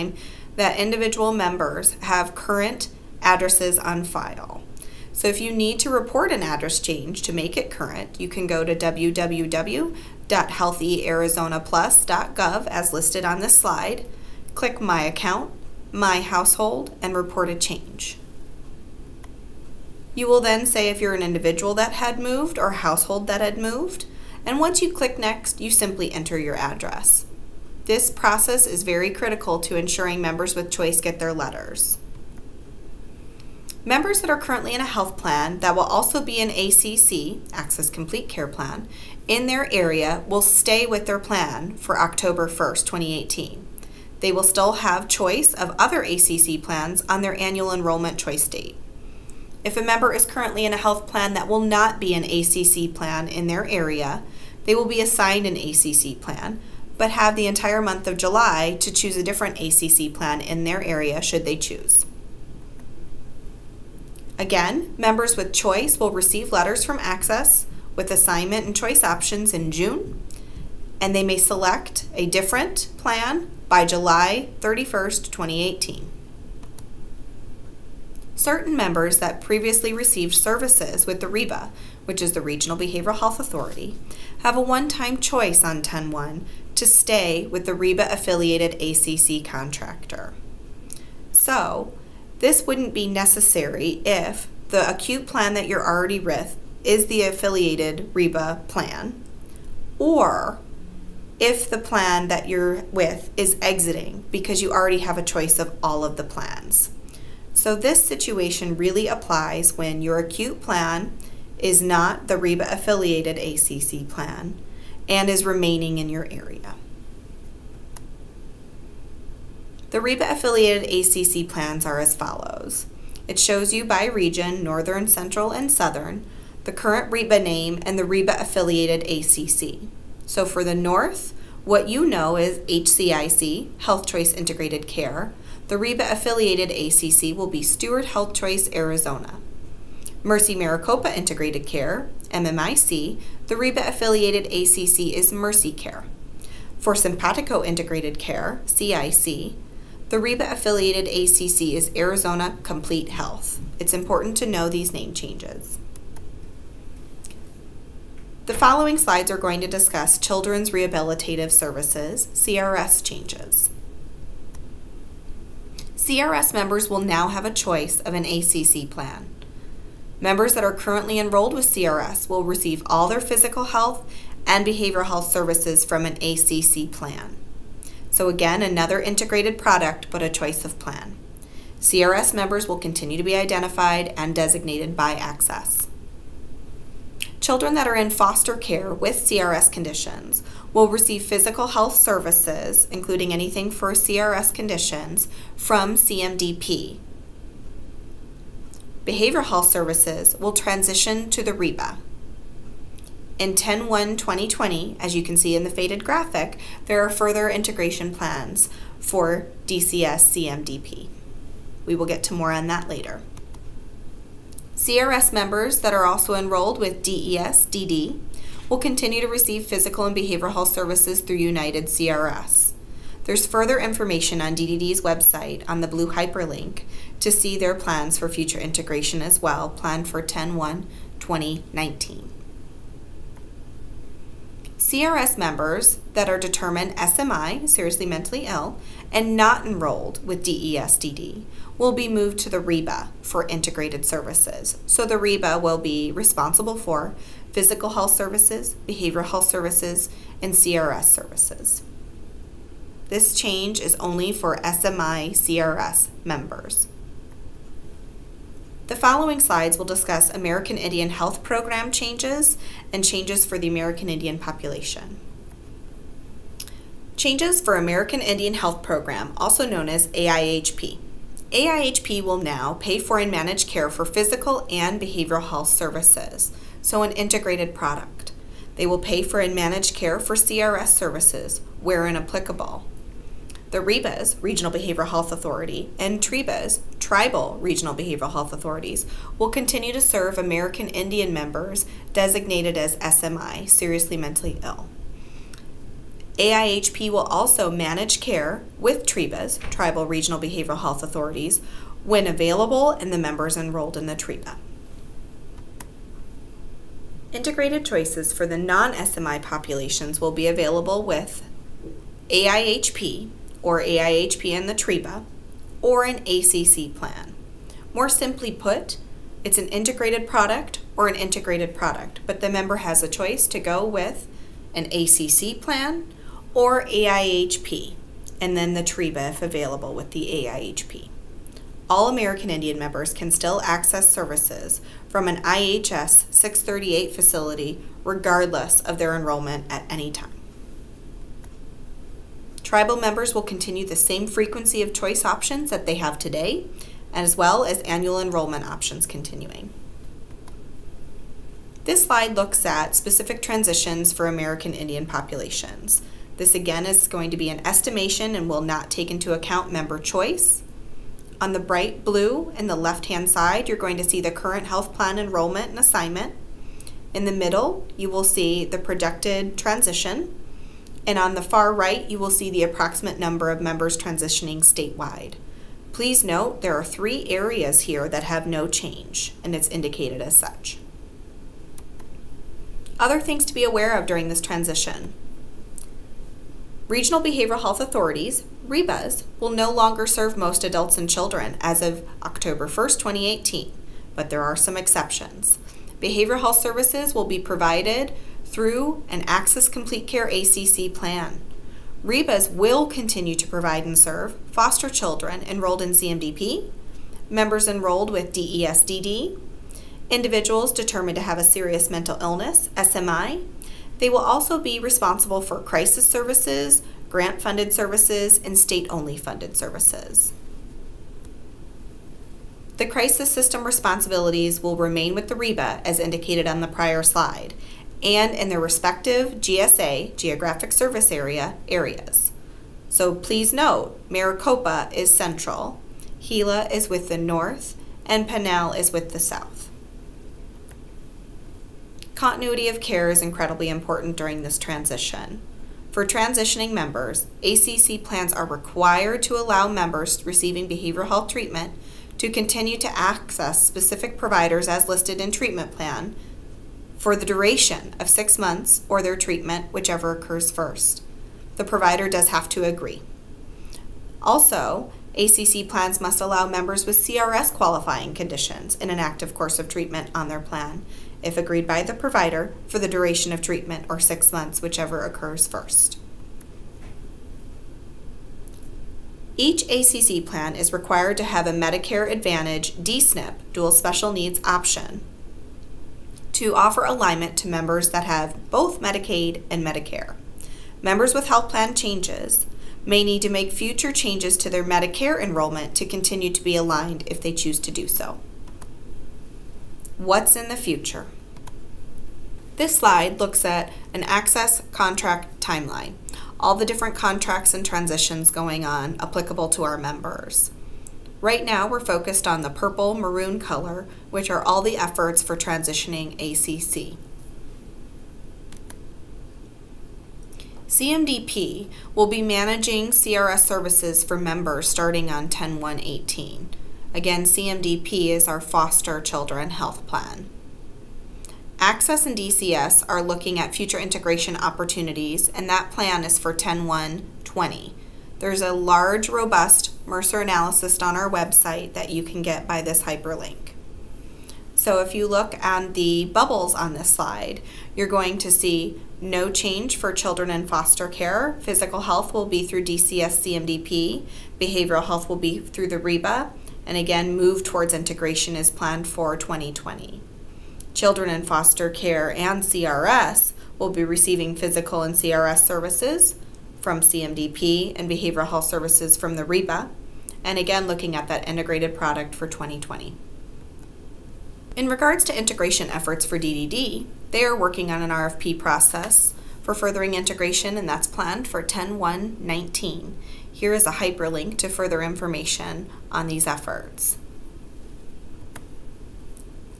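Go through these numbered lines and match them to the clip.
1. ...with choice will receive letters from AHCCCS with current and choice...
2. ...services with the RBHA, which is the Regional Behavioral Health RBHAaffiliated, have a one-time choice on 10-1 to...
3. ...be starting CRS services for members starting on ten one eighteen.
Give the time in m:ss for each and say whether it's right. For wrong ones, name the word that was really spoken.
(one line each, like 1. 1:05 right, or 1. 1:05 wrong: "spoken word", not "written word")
1. 1:05 wrong: "assignment", not "current"
2. 1:20 wrong: "Authority", not "RBHAaffiliated"
3. 8:42 wrong: "managing", not "starting".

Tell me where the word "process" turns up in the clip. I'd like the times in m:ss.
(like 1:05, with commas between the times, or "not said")
0:28, 9:38.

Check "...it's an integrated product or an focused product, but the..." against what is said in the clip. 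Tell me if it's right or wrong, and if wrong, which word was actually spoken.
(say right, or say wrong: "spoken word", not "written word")
wrong: "integrated", not "focused".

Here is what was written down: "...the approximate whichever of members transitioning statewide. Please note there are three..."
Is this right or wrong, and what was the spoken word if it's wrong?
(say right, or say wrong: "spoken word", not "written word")
wrong: "number", not "whichever".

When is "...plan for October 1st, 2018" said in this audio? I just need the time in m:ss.
0:41.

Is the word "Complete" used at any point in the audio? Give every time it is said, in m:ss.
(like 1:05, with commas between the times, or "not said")
0:37, 2:32, 6:39.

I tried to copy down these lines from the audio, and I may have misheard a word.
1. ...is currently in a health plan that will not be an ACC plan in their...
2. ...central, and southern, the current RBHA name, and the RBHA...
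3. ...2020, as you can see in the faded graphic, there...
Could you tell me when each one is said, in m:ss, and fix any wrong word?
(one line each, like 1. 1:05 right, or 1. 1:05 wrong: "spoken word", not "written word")
1. 0:50 right
2. 2:05 right
3. 3:24 right.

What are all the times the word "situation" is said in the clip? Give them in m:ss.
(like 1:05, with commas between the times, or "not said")
1:48.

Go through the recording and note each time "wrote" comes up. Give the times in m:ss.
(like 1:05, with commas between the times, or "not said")
not said.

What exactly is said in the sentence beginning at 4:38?
They will pay for and manage care for CRS services, wherein applicable.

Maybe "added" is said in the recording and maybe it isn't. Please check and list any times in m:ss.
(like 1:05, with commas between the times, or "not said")
not said.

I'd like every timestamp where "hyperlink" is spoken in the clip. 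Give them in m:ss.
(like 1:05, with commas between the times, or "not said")
3:46, 9:02, 9:43.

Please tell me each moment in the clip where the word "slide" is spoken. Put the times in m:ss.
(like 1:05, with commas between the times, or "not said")
0:13, 2:38, 4:19, 5:52, 7:07, 8:22, 9:06.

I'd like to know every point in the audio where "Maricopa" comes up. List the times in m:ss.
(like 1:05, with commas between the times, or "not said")
2:20, 7:14.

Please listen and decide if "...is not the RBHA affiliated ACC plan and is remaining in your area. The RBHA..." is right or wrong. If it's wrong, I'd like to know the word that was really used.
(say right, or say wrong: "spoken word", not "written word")
right.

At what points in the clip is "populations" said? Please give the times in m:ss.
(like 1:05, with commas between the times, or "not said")
4:24, 5:09, 5:55.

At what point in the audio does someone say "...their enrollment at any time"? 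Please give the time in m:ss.
5:38.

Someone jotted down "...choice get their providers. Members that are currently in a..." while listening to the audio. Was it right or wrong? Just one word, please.
wrong.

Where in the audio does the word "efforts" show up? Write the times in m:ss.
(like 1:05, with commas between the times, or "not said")
8:34, 9:35, 9:46.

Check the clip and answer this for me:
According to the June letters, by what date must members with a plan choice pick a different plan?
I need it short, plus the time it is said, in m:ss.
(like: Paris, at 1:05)
July 31st, 2018, at 1:13.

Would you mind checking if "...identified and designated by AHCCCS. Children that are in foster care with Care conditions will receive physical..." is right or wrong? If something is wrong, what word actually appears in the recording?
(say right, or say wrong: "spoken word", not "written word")
wrong: "CRS", not "Care".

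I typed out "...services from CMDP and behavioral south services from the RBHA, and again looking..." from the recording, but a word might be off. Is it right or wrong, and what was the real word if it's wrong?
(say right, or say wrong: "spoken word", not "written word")
wrong: "health", not "south".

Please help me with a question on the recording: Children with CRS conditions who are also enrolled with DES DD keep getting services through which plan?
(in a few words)
United CRS.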